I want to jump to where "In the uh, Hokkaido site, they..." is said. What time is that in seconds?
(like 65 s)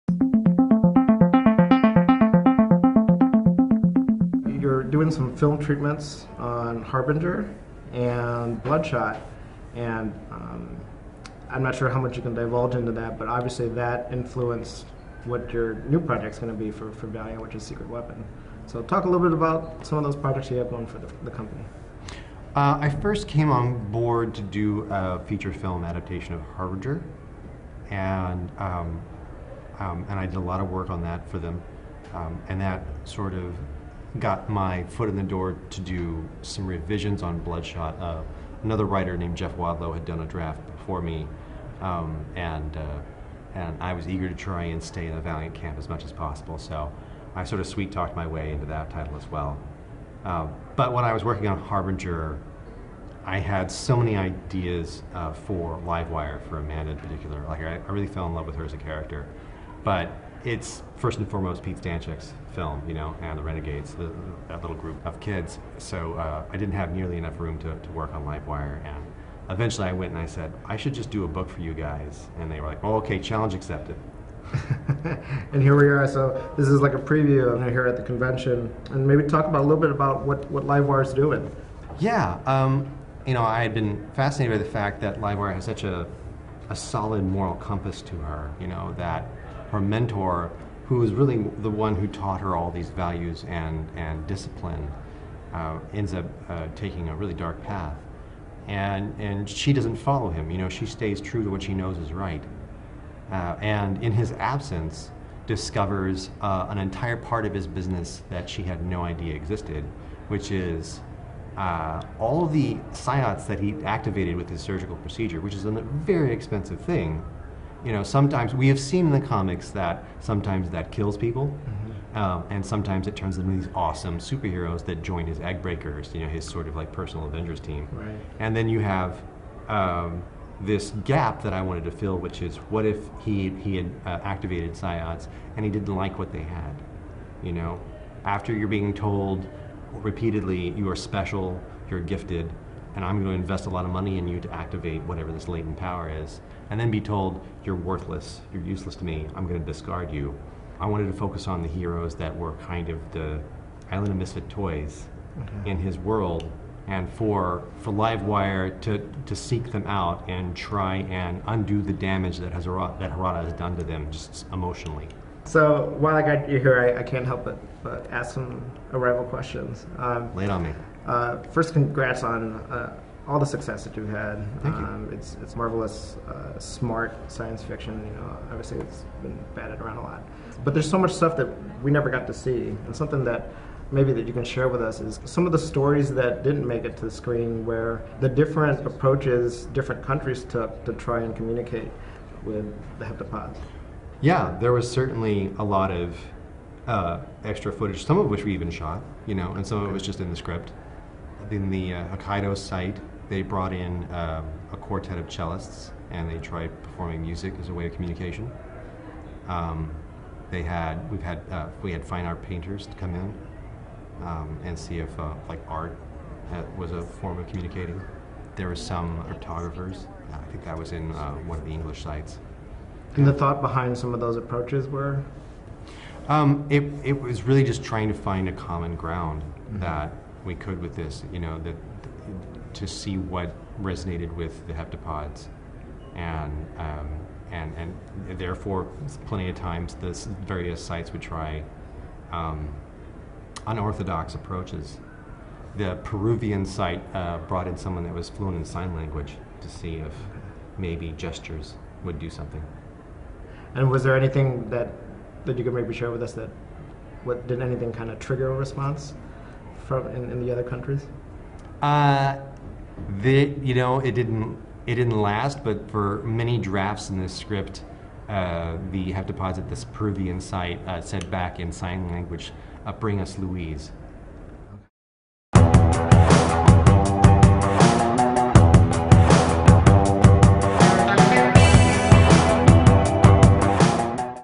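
201 s.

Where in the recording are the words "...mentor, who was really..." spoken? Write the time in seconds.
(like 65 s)
89 s.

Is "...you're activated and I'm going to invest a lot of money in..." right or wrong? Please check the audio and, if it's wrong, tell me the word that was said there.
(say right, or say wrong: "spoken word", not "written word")
wrong: "gifted", not "activated".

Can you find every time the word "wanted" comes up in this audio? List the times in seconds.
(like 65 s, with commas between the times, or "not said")
131 s, 150 s.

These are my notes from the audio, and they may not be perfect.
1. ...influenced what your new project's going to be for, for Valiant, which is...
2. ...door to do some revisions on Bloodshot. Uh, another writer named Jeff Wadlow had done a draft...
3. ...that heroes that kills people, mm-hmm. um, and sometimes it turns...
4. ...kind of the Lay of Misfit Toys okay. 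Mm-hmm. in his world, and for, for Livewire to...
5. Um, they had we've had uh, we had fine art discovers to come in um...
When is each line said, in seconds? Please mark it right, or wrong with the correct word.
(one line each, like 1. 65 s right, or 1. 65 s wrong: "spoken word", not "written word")
1. 14 s right
2. 35 s right
3. 119 s wrong: "sometimes", not "heroes"
4. 152 s wrong: "Island", not "Lay"
5. 209 s wrong: "painters", not "discovers".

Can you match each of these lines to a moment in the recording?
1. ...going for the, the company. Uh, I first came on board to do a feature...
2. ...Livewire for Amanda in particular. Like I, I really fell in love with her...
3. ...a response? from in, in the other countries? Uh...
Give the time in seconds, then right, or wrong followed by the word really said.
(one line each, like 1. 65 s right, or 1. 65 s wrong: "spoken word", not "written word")
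1. 20 s right
2. 55 s right
3. 258 s right.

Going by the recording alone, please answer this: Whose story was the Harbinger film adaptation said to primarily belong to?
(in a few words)
Pete Stanchek.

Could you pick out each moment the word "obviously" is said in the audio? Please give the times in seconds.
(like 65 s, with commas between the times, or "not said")
13 s, 178 s.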